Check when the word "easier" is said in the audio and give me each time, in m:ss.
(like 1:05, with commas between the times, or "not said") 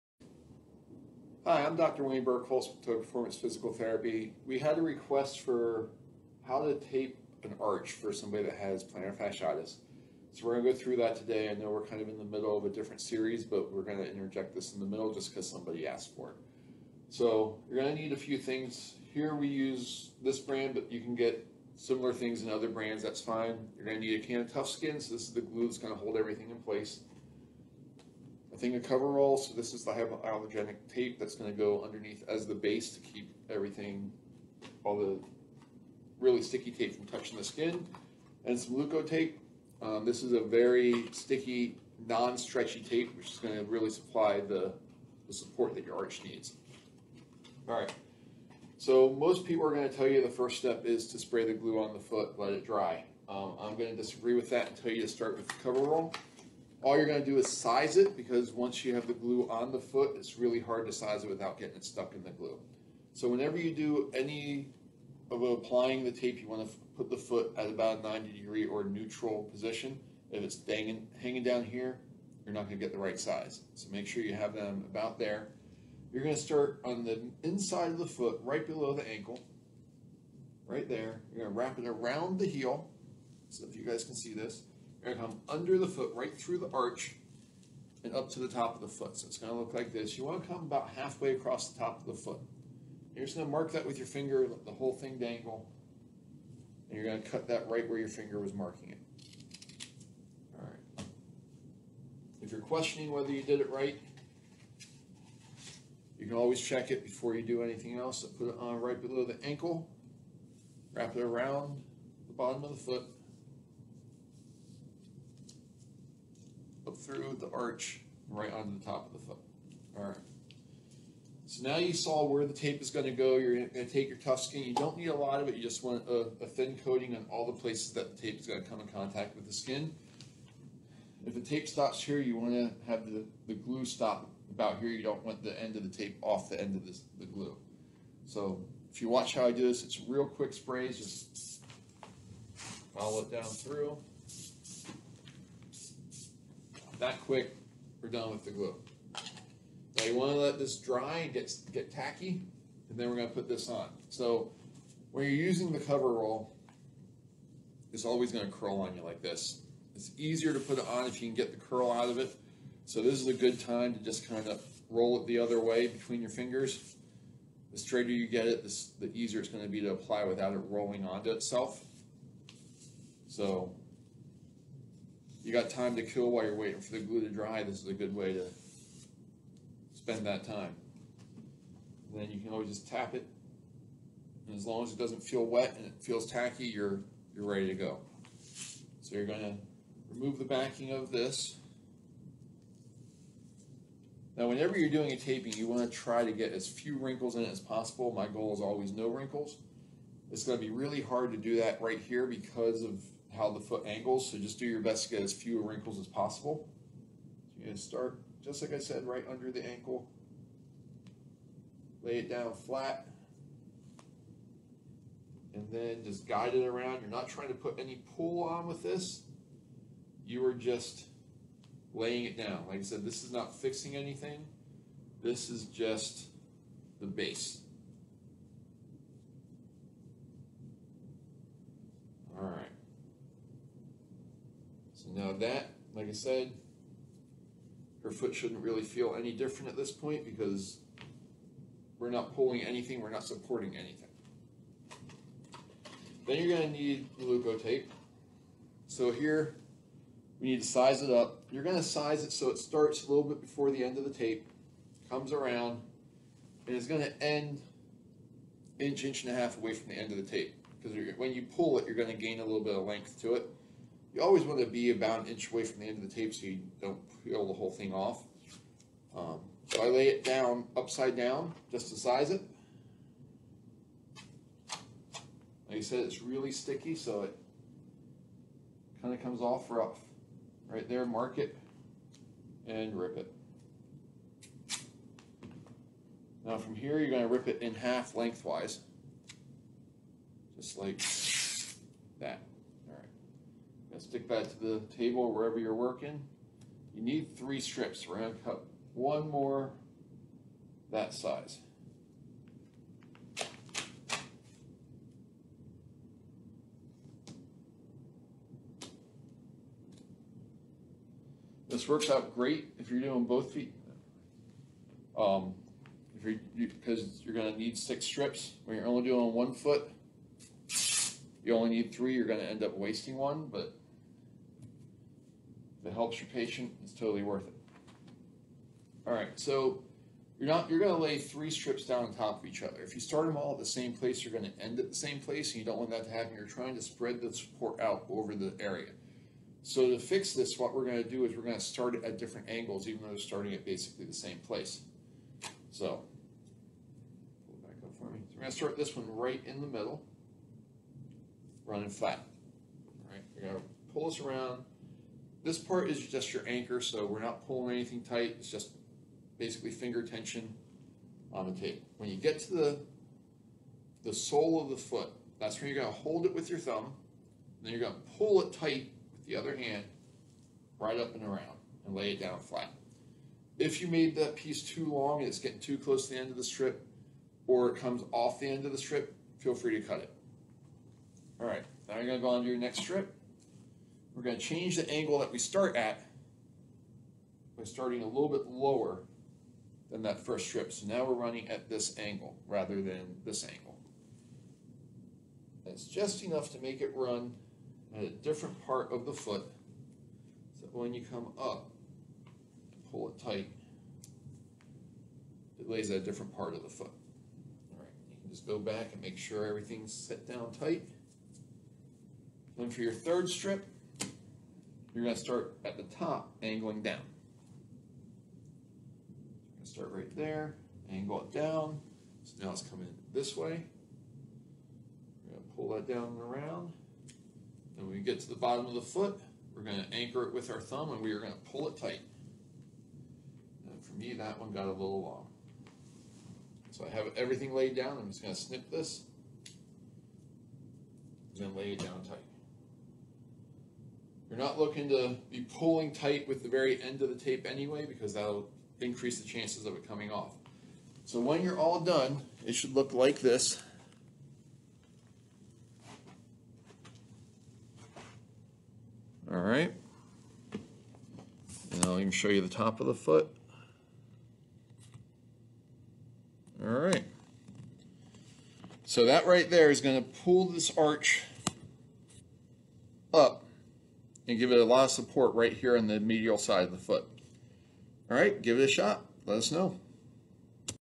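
2:40, 2:49.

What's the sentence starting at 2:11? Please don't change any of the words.
If the tape stops here, you want to have the, the glue stop about here.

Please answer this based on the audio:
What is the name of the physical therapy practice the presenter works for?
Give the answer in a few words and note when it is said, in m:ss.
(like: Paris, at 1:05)
Performance Physical Therapy, at 0:02.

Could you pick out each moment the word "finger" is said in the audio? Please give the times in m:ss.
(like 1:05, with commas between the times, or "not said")
1:34, 1:38, 2:46, 5:59.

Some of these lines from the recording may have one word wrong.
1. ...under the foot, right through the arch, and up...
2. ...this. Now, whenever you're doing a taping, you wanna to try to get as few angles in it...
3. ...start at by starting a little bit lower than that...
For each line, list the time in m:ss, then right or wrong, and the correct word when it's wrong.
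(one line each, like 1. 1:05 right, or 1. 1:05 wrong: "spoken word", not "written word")
1. 1:25 right
2. 3:11 wrong: "wrinkles", not "angles"
3. 6:25 right.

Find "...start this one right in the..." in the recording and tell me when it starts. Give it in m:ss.
5:48.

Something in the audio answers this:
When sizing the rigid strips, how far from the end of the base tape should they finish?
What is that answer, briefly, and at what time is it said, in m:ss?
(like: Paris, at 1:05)
inch and a half, at 4:18.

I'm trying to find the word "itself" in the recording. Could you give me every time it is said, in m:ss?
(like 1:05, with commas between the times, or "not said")
2:51.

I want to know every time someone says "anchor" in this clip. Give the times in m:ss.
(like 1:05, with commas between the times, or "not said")
5:56, 7:09.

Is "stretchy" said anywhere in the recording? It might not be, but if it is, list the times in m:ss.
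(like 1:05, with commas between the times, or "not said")
0:42.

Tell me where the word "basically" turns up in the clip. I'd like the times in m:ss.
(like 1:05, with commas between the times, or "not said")
5:43, 5:59.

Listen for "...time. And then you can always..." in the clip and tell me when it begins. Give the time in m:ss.
3:00.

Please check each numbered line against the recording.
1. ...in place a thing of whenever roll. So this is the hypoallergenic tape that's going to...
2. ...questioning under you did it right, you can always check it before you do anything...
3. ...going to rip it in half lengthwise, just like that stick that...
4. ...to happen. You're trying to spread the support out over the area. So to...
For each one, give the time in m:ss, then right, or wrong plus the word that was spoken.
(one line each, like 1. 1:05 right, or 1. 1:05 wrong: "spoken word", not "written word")
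1. 0:26 wrong: "cover", not "whenever"
2. 1:42 wrong: "whether", not "under"
3. 4:47 right
4. 5:36 right.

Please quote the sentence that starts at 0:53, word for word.
Um, I'm going to disagree with that and tell you to start with the cover roll.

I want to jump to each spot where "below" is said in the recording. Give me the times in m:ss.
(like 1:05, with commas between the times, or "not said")
1:18, 1:48.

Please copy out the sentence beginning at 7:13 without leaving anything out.
And for me, that one got a little long.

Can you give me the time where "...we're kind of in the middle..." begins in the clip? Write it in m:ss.
0:11.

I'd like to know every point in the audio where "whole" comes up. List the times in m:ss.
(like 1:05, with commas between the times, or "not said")
1:34, 4:27.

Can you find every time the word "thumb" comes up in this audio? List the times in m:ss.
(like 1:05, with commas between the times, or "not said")
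6:06, 7:10.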